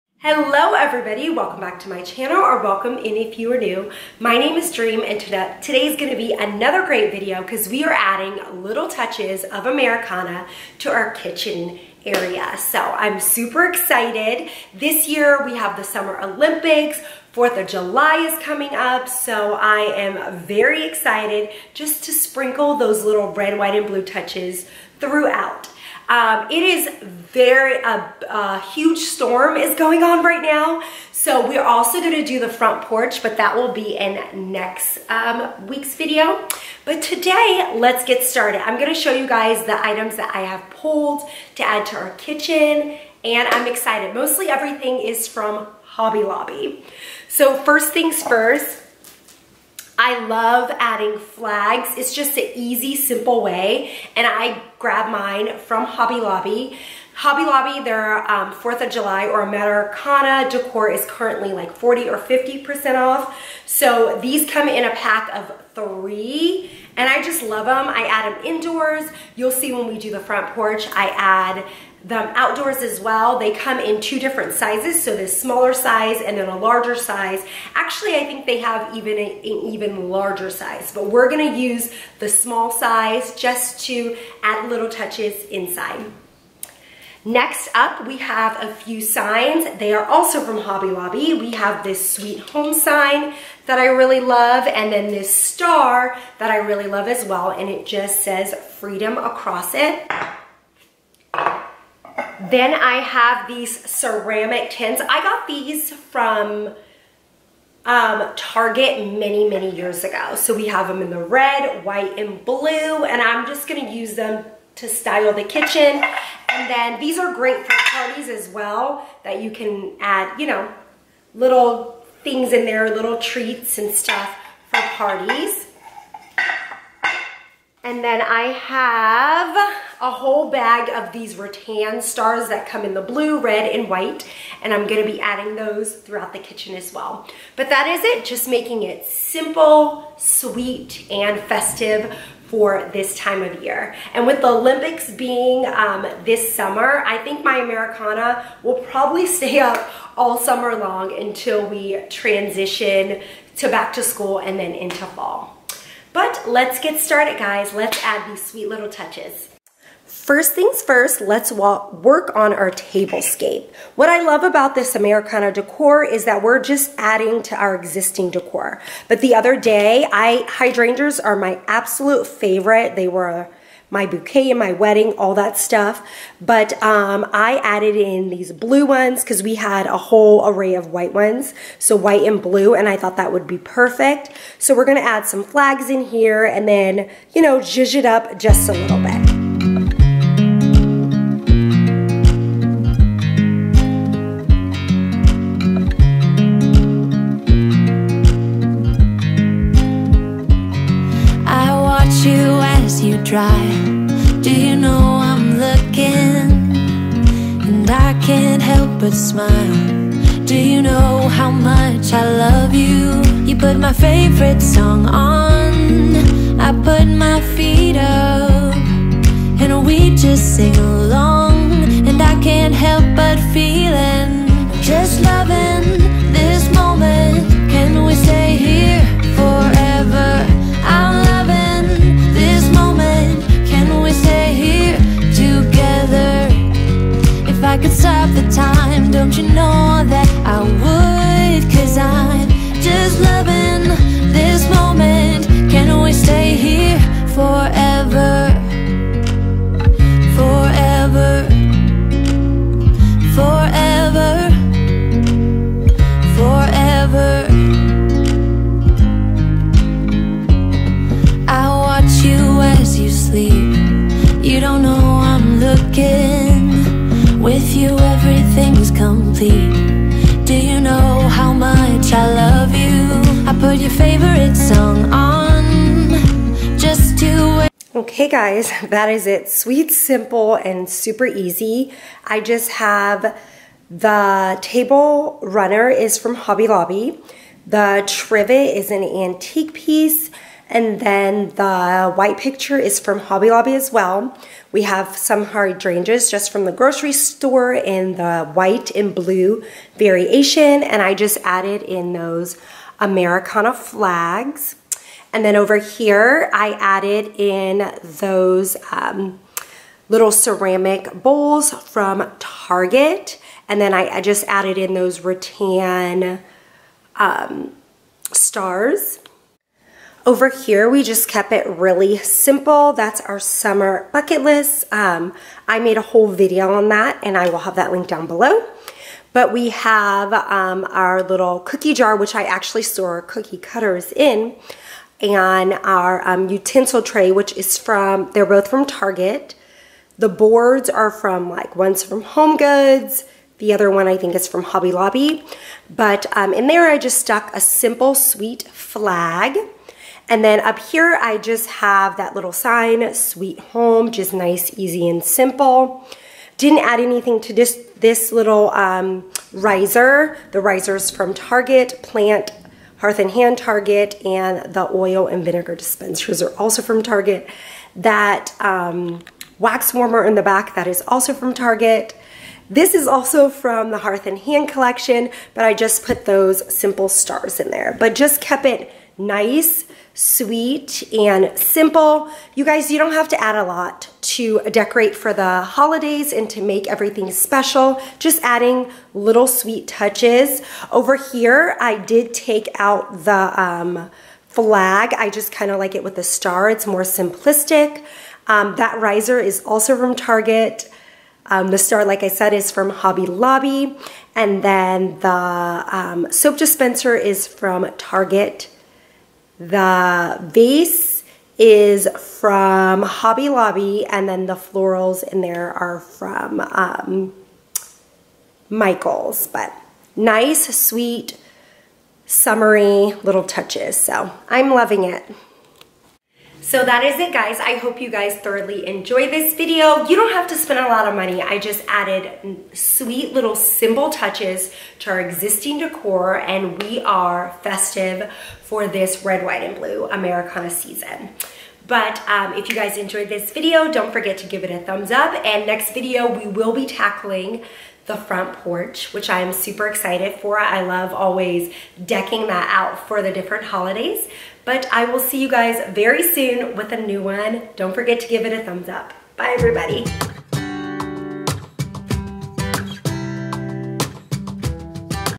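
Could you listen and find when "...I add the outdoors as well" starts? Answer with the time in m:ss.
1:10.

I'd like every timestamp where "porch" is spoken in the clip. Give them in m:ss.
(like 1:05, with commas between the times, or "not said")
0:32, 1:10, 7:28.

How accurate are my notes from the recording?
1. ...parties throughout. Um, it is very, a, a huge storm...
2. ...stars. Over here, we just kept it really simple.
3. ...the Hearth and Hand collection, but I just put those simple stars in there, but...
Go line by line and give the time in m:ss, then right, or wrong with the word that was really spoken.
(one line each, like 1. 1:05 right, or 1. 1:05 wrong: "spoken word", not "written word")
1. 0:24 wrong: "touches", not "parties"
2. 5:18 right
3. 6:13 right.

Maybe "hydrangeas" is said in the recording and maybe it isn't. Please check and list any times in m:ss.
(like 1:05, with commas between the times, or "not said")
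2:50, 4:55.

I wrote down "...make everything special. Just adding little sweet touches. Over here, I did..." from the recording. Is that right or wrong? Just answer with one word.
right.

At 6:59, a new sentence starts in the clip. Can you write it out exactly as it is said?
But nice, sweet, summery little touches.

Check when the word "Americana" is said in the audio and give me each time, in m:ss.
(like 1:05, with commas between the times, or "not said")
0:09, 0:59, 2:27, 2:44, 5:03, 7:20.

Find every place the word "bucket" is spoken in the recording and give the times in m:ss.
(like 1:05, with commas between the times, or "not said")
5:24.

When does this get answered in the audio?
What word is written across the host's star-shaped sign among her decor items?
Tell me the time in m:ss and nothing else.
1:38.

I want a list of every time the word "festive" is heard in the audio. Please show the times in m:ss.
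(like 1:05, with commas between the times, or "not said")
2:21, 7:17.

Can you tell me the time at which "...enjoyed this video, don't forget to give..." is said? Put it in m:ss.
7:22.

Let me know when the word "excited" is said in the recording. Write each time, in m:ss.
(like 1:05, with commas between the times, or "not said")
0:13, 0:20, 0:43, 7:29.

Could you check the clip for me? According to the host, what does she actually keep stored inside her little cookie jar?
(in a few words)
cookie cutters.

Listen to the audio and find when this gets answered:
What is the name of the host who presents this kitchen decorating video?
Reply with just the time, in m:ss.
0:04.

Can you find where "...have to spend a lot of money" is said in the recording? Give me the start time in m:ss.
7:10.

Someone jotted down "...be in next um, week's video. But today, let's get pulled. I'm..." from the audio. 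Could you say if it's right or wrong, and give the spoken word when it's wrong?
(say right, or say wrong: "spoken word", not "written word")
wrong: "started", not "pulled".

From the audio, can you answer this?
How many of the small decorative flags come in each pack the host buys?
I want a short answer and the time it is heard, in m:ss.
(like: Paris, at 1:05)
3, at 1:05.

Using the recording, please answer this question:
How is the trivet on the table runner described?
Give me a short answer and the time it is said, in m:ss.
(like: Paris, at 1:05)
antique, at 4:49.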